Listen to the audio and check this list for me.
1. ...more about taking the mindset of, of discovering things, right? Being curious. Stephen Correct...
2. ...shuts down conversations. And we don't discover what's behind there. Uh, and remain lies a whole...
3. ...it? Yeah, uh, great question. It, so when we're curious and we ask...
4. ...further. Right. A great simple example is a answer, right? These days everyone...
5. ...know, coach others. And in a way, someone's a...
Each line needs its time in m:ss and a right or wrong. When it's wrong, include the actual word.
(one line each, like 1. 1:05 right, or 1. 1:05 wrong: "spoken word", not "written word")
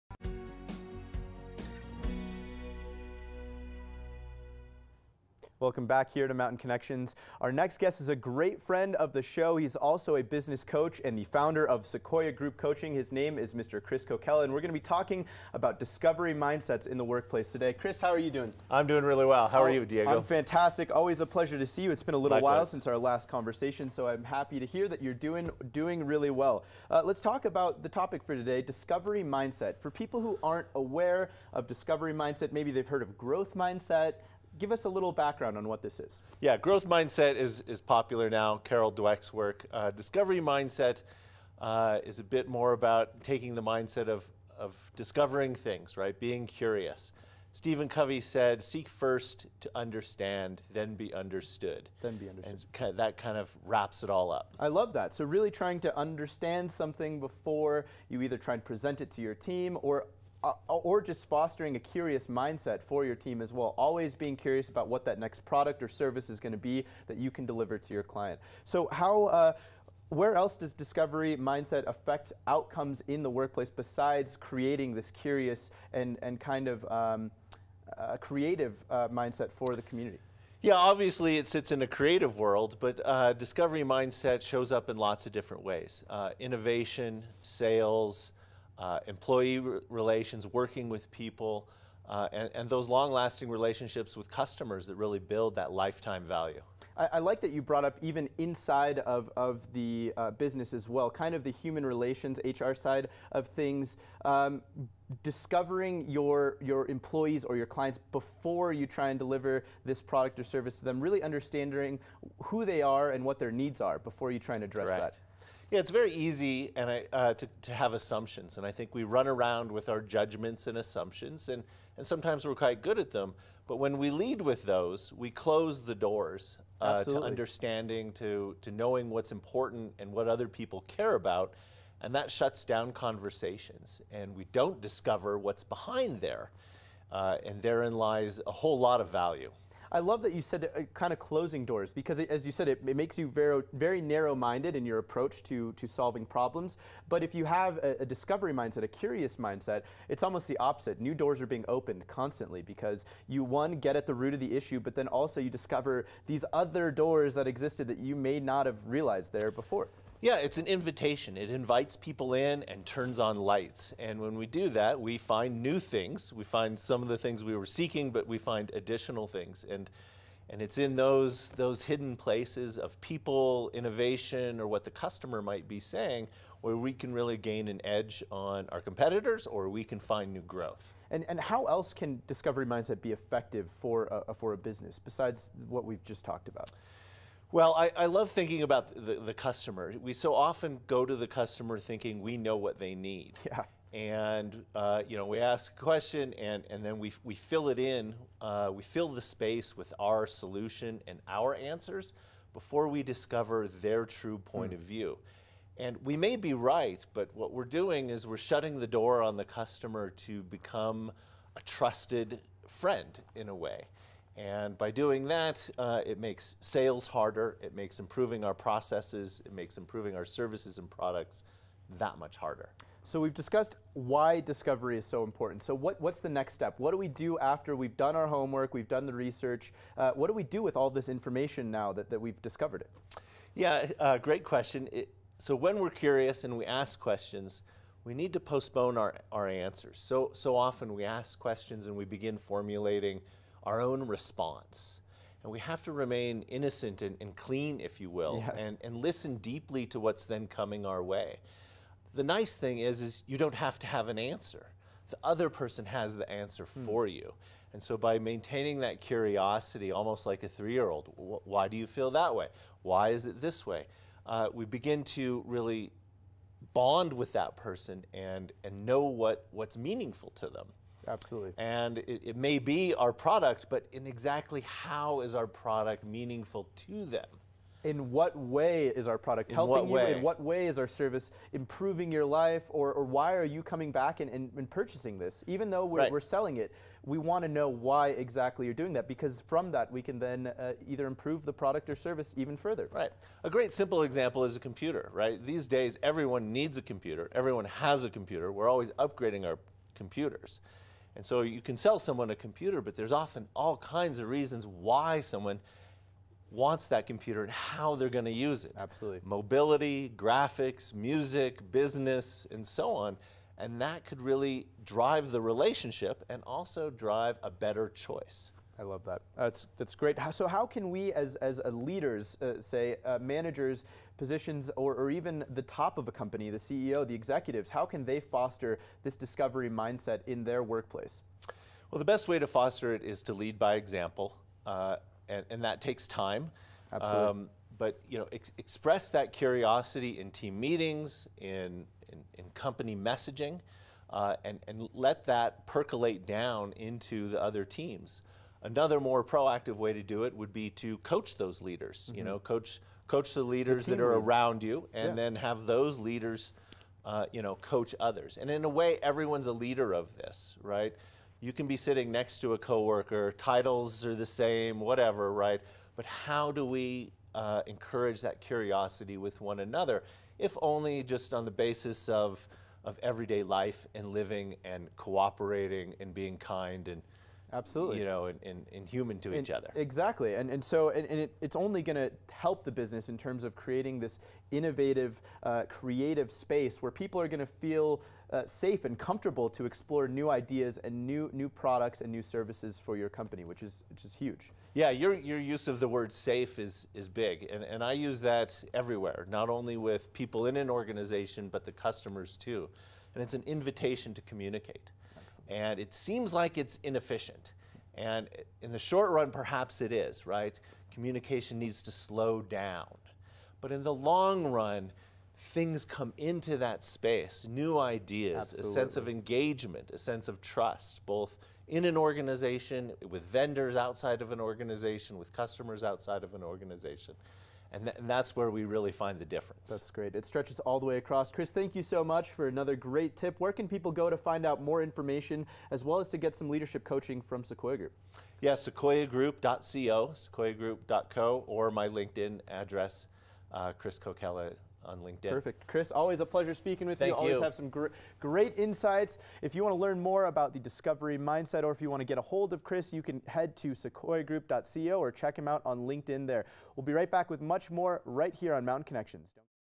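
1. 0:42 wrong: "Covey", not "Correct"
2. 2:12 wrong: "therein", not "remain"
3. 3:52 right
4. 4:52 wrong: "computer", not "answer"
5. 5:57 wrong: "everyone", not "someone".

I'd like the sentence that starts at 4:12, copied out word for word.
The nice thing is, is you don't have to have an answer.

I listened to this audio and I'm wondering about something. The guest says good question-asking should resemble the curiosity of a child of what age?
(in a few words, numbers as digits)
3.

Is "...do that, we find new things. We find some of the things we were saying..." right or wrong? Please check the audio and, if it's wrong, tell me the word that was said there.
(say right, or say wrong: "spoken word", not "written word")
wrong: "seeking", not "saying".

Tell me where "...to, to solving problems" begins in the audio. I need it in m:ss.
2:25.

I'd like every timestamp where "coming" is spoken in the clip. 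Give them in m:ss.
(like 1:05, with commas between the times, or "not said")
4:10, 4:43.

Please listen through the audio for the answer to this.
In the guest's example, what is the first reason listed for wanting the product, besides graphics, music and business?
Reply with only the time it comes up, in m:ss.
5:09.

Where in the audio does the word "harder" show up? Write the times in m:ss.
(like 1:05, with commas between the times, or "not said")
3:37, 3:42.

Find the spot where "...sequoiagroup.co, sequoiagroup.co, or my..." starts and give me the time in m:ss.
7:18.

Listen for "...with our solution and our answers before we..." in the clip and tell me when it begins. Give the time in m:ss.
3:19.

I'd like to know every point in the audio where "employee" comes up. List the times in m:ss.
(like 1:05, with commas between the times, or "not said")
1:29, 1:46.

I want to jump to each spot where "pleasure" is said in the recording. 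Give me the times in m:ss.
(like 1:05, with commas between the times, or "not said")
0:21, 7:26.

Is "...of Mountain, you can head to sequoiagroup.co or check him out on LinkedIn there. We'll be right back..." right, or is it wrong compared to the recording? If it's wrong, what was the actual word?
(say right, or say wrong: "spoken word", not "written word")
wrong: "Chris", not "Mountain".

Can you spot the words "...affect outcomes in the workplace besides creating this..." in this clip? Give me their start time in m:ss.
1:11.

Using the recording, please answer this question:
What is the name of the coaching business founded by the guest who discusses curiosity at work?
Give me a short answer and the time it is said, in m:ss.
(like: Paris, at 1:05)
Sequoia Group Coaching, at 0:11.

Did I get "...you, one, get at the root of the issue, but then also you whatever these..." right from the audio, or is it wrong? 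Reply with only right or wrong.
wrong.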